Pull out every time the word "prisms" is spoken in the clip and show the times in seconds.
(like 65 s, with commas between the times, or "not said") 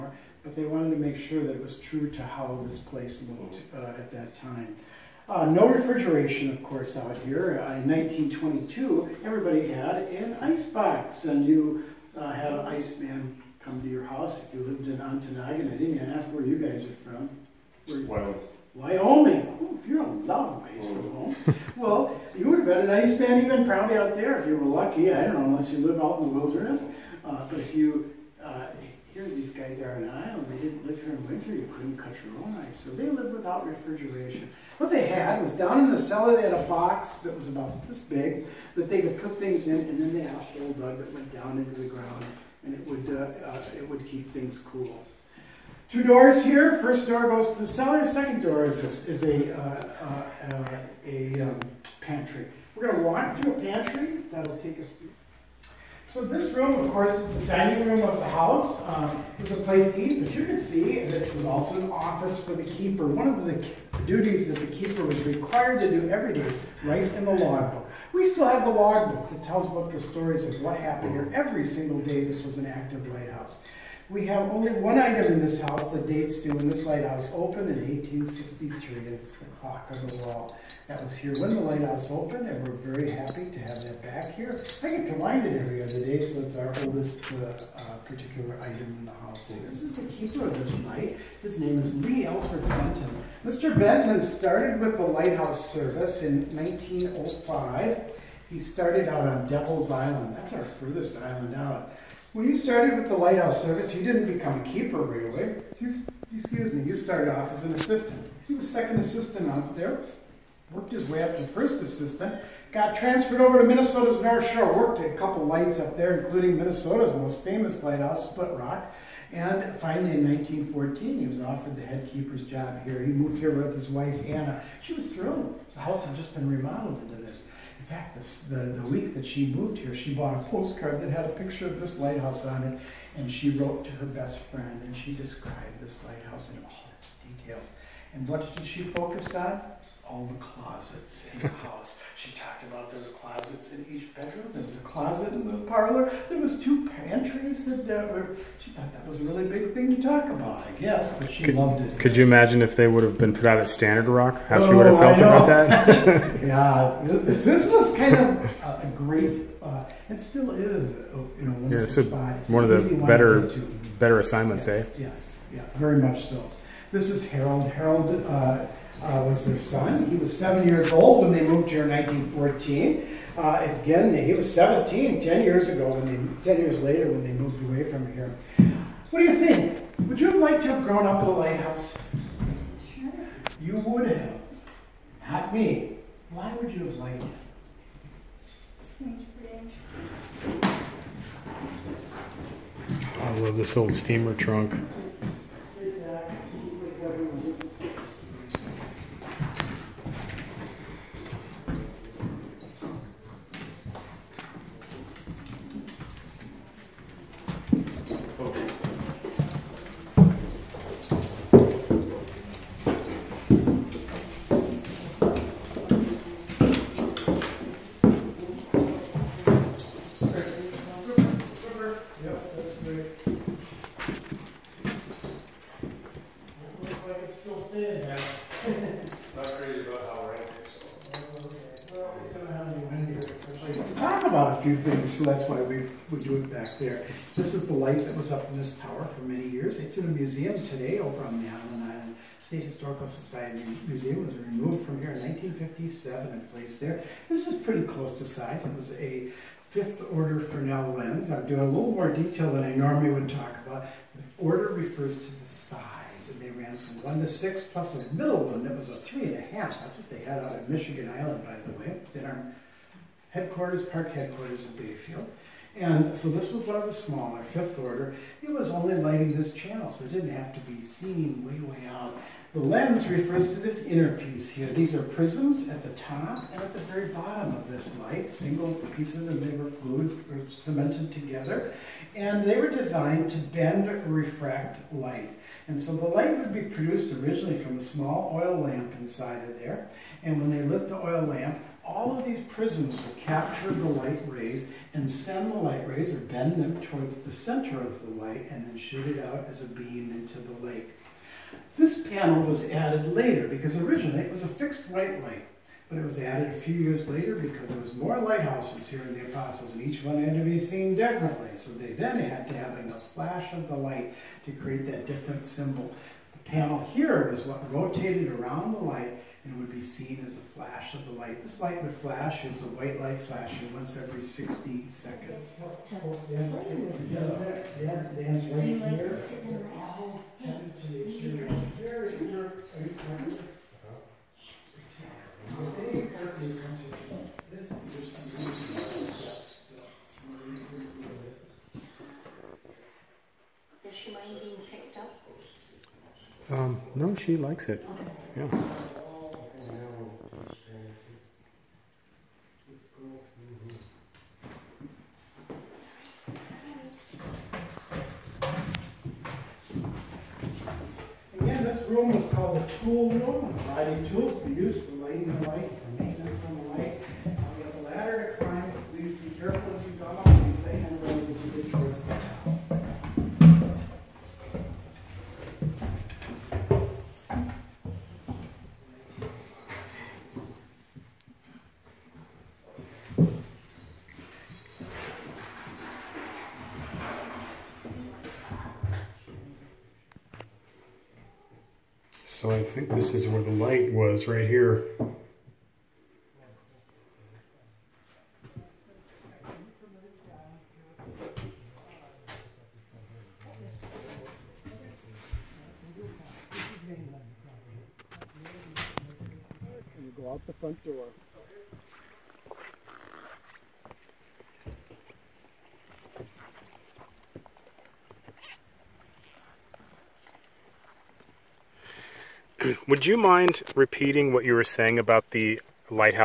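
275 s, 292 s.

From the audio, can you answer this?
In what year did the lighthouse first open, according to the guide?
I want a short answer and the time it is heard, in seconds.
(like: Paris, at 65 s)
1863, at 77 s.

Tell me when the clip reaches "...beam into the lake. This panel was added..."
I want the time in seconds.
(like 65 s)
299 s.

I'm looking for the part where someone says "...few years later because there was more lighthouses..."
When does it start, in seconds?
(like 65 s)
306 s.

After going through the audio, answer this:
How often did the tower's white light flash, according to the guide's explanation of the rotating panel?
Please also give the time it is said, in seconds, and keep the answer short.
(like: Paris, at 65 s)
Once every 60 seconds, at 323 s.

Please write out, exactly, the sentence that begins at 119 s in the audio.
And finally, in 1914, he was offered the head keeper's job here.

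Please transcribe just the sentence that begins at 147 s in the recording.
That, uh, she thought that was a really big thing to talk about, I guess, but she could, loved it.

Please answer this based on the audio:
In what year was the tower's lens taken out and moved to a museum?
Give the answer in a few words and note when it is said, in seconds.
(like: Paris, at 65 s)
1957, at 245 s.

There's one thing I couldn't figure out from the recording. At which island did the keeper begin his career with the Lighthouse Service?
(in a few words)
Devil's Island.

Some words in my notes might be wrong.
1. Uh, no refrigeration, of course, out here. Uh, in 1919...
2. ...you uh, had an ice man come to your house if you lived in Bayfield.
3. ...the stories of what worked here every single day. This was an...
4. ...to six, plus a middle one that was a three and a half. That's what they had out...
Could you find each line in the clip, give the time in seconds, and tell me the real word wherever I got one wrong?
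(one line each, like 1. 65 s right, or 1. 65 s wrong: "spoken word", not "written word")
1. 5 s wrong: "1922", not "1919"
2. 11 s wrong: "Ontonagon", not "Bayfield"
3. 69 s wrong: "happened", not "worked"
4. 257 s right.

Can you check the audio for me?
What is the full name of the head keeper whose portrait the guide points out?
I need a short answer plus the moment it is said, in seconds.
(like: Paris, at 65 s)
Lee Ellsworth Benton, at 91 s.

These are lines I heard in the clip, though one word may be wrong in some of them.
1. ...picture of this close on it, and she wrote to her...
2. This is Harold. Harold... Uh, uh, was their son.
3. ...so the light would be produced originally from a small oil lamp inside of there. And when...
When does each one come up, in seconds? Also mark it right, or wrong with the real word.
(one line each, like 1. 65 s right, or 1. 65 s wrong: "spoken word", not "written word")
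1. 131 s wrong: "lighthouse", not "close"
2. 166 s right
3. 285 s right.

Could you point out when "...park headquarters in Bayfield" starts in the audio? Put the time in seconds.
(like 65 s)
263 s.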